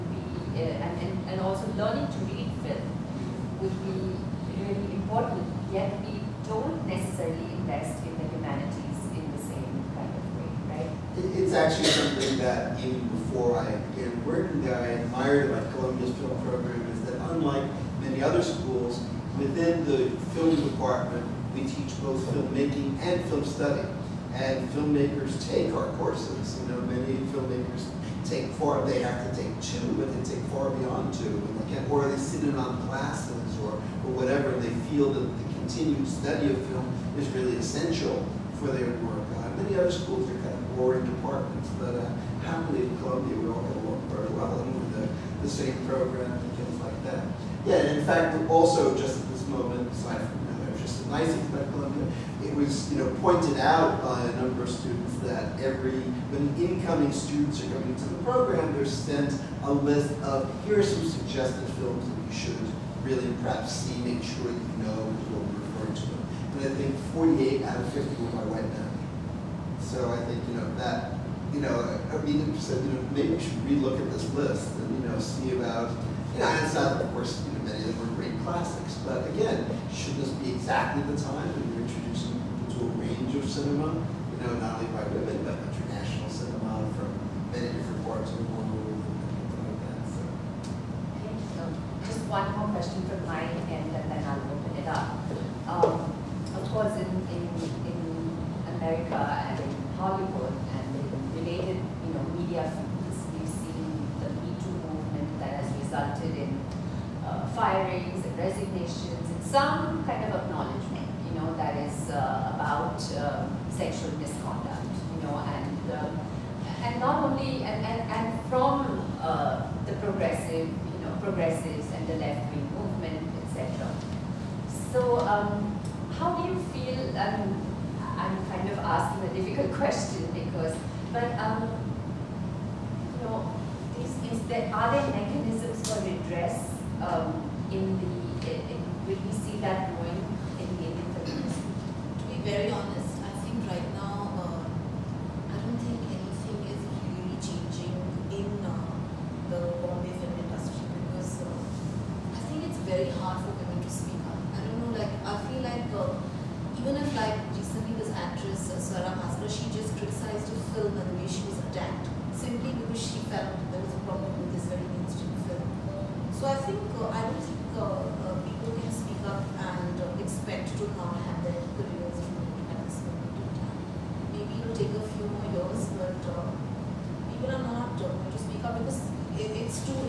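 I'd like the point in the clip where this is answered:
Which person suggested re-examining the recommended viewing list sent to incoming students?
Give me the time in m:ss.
1:12.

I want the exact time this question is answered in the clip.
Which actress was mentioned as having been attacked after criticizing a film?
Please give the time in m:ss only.
2:38.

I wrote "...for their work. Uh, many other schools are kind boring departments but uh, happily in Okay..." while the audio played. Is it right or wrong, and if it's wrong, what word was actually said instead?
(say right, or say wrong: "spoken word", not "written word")
wrong: "Columbia", not "Okay".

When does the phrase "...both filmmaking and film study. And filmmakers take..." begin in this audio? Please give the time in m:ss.
0:22.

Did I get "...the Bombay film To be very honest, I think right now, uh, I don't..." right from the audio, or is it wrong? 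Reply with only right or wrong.
wrong.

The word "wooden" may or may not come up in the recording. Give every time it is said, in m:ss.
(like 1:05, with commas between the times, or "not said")
not said.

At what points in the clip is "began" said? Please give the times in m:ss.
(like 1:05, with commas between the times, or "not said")
0:13.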